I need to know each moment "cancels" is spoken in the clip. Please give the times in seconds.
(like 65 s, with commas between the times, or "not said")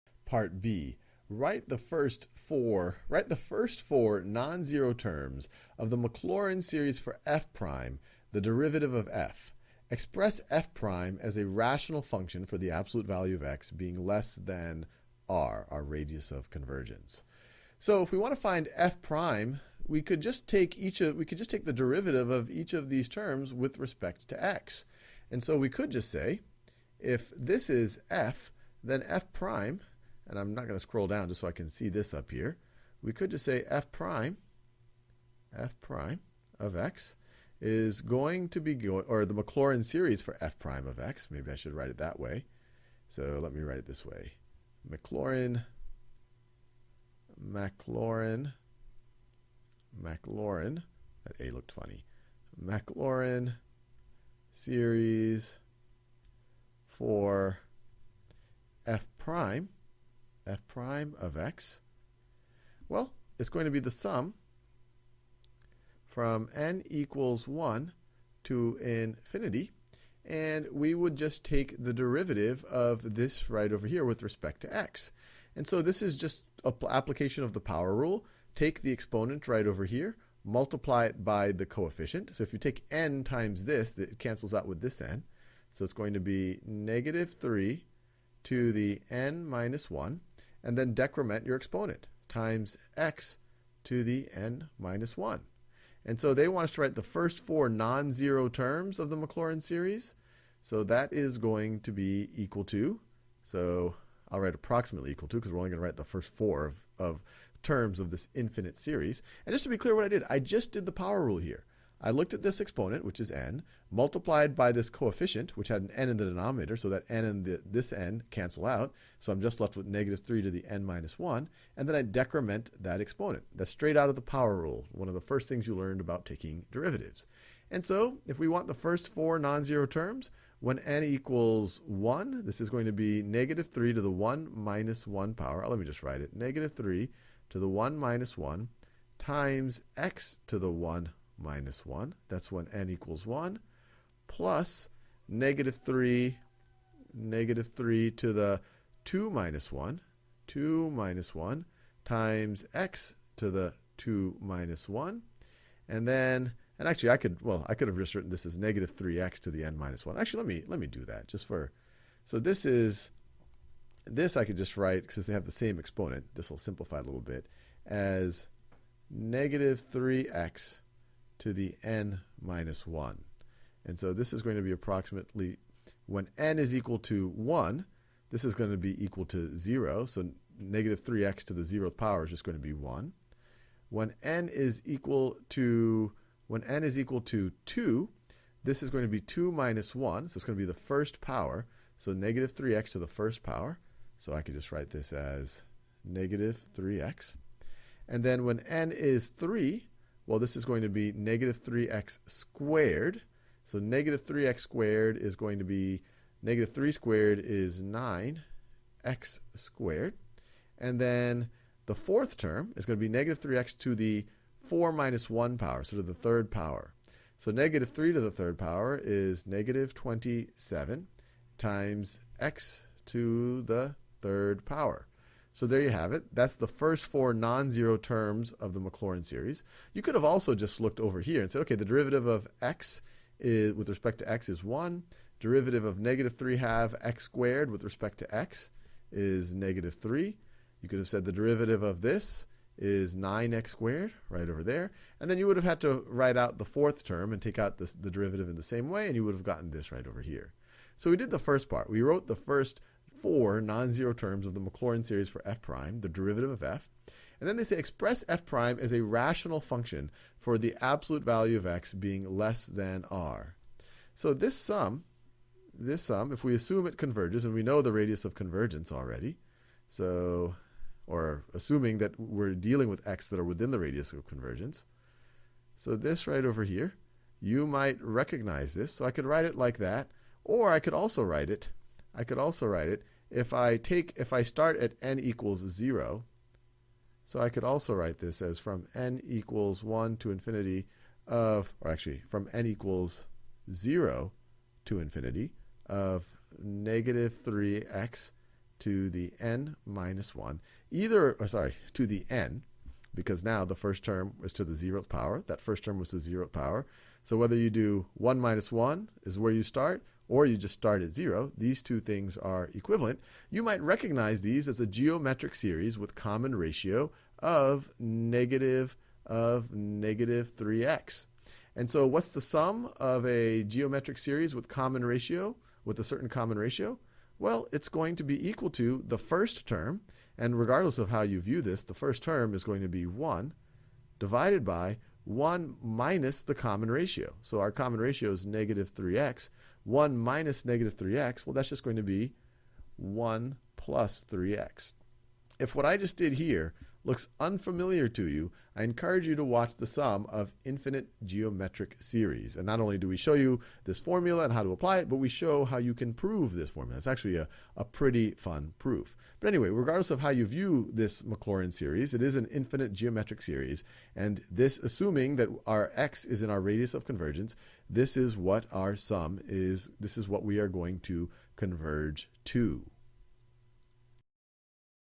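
84 s, 118 s.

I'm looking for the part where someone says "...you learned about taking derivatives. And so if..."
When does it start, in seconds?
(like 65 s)
125 s.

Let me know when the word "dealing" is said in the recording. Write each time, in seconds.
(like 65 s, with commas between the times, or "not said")
272 s.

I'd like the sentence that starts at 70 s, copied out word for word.
And we would just take the derivative of this right over here with respect to x.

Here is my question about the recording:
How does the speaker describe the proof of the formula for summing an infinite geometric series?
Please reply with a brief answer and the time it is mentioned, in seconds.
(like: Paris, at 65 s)
pretty fun, at 357 s.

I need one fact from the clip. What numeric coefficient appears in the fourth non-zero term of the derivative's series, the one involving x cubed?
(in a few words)
-27.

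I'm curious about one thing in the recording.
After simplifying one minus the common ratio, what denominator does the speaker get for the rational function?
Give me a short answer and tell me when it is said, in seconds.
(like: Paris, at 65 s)
1 + 3x, at 342 s.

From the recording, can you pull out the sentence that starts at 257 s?
And then they say express f prime as a rational function for the absolute value of x being less than r.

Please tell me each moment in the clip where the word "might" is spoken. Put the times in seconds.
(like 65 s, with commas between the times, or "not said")
277 s, 313 s.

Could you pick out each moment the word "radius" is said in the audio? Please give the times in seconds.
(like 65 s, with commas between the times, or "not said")
15 s, 267 s, 273 s, 366 s.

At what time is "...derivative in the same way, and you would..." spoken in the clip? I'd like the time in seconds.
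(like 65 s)
248 s.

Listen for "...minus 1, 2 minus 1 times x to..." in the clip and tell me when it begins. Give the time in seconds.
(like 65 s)
149 s.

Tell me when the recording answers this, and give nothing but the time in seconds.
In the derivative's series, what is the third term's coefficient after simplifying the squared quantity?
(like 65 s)
206 s.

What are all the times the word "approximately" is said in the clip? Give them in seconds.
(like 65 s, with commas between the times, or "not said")
104 s, 174 s.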